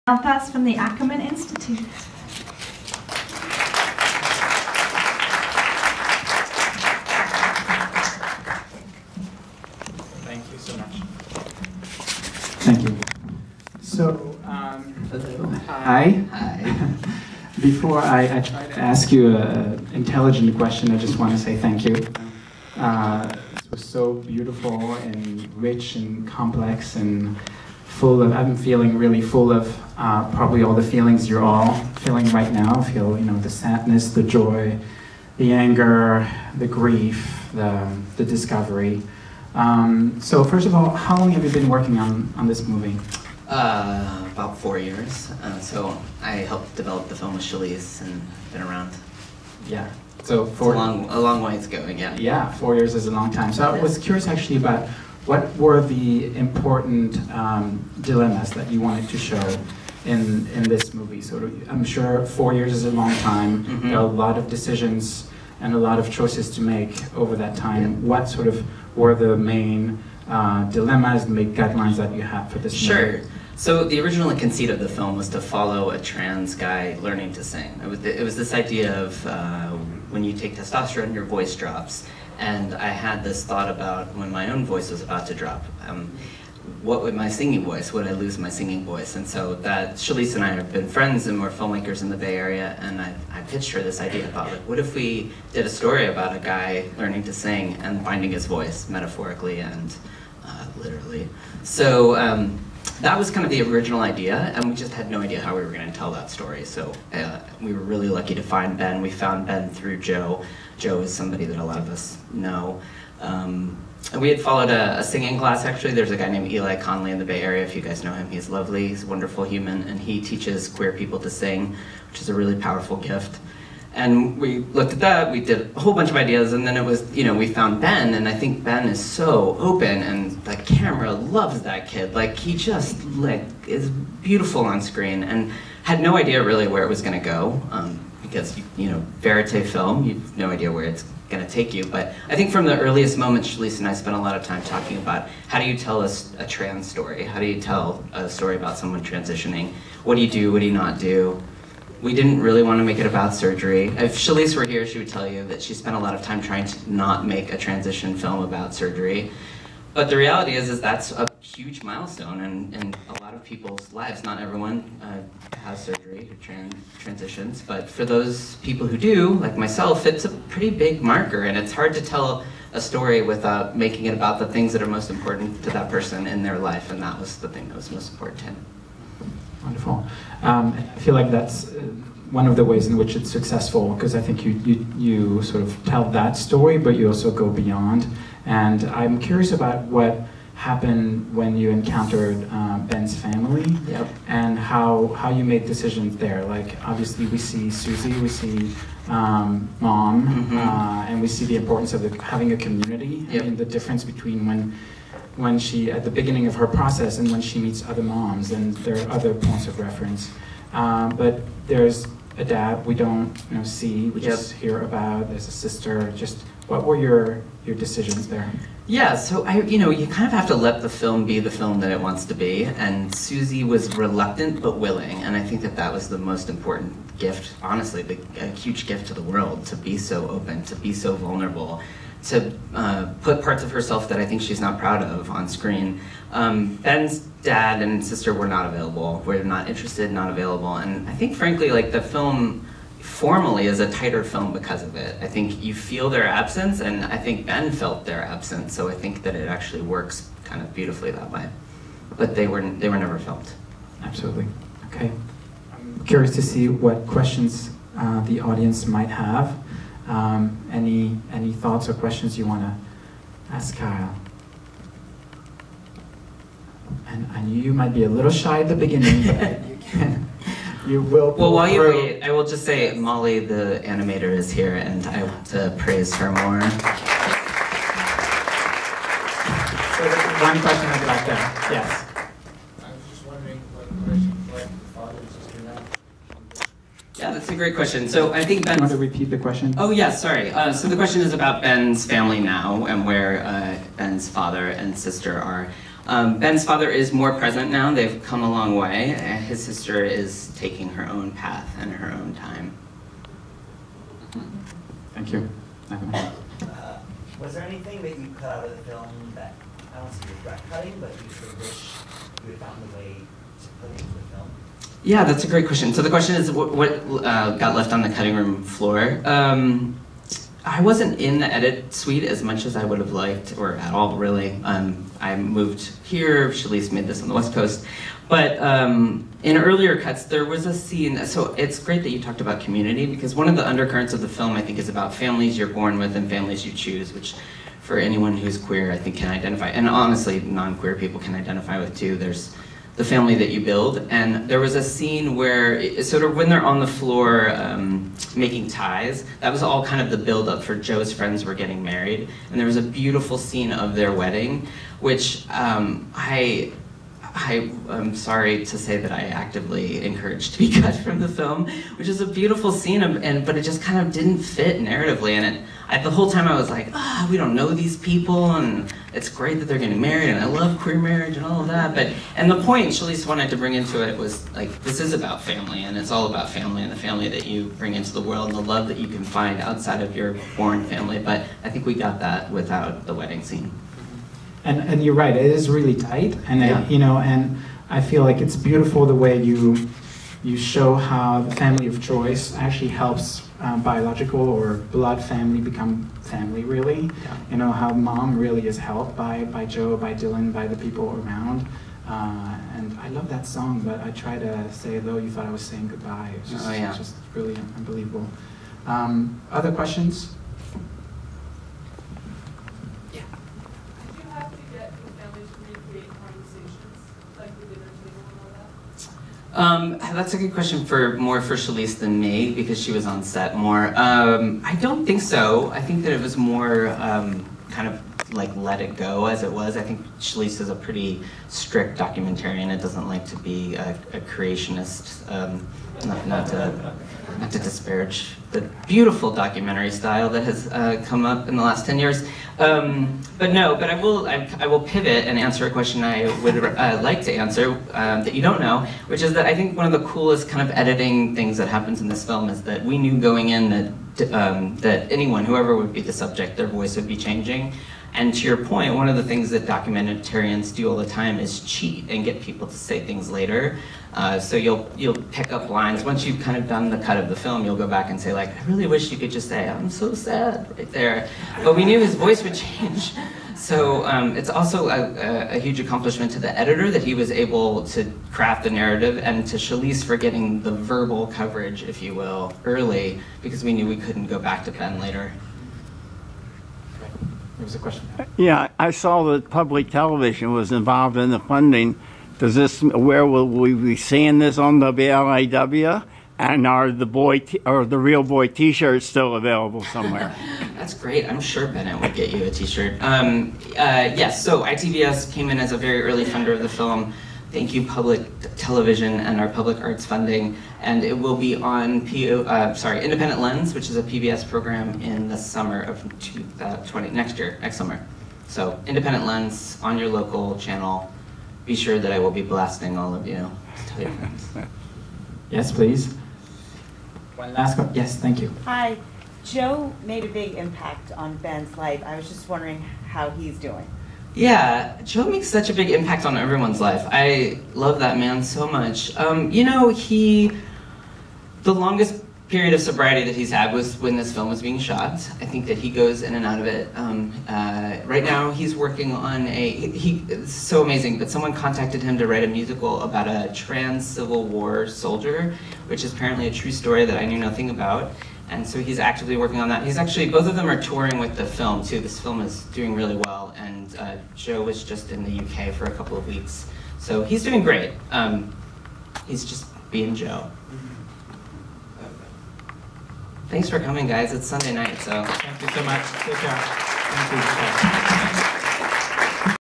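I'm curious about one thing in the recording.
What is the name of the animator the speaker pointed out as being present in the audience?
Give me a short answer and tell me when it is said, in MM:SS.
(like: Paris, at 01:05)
Molly, at 04:32.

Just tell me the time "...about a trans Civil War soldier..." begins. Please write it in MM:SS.
09:13.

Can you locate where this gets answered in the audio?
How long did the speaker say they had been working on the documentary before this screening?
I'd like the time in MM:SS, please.
00:44.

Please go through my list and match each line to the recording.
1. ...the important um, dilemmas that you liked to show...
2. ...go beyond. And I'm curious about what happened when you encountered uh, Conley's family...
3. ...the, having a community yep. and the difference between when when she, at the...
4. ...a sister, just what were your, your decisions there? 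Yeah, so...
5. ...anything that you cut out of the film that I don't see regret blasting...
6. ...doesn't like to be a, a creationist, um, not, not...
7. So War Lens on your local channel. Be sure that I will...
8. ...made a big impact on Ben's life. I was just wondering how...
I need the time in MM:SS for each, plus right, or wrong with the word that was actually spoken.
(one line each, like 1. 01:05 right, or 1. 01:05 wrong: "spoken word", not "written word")
1. 00:55 wrong: "wanted", not "liked"
2. 03:07 wrong: "Ben", not "Conley"
3. 03:22 right
4. 03:35 right
5. 05:07 wrong: "cutting", not "blasting"
6. 07:12 right
7. 08:38 wrong: "Independent", not "War"
8. 08:50 right.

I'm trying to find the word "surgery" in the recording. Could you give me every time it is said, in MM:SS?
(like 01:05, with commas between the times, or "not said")
02:33, 02:38, 02:45.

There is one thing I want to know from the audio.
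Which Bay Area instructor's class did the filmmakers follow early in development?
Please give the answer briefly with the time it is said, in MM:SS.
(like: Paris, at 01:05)
Eli Conley, at 01:56.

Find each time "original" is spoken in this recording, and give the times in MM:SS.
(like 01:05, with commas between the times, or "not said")
01:14, 01:43.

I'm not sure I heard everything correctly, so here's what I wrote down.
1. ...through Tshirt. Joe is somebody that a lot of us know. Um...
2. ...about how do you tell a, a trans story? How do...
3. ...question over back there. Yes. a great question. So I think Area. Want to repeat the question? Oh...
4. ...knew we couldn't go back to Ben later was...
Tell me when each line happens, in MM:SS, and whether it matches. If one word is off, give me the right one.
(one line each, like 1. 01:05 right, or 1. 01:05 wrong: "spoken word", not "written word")
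1. 01:49 wrong: "Joe", not "Tshirt"
2. 02:24 right
3. 04:40 wrong: "Ben", not "Area"
4. 08:03 right.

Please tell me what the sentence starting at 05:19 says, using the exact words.
Um, I wasn't in the edit suite as much as I would have liked, or at all, really.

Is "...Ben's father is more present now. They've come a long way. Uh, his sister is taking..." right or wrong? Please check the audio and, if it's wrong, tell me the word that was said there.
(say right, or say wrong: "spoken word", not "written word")
right.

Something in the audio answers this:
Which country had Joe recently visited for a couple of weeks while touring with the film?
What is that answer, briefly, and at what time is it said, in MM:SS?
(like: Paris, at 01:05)
UK, at 09:25.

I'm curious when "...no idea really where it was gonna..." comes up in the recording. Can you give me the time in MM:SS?
02:15.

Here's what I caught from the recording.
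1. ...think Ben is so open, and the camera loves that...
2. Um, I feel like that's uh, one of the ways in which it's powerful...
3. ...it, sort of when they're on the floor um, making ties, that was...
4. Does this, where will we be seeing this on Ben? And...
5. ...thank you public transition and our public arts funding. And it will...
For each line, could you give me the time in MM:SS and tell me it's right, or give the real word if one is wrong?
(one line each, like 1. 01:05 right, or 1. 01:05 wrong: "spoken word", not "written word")
1. 02:08 right
2. 03:00 wrong: "successful", not "powerful"
3. 05:45 right
4. 08:12 wrong: "WLIW", not "Ben"
5. 08:27 wrong: "television", not "transition".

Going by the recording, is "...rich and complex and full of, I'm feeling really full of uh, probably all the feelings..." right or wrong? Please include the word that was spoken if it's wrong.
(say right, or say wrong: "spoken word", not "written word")
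right.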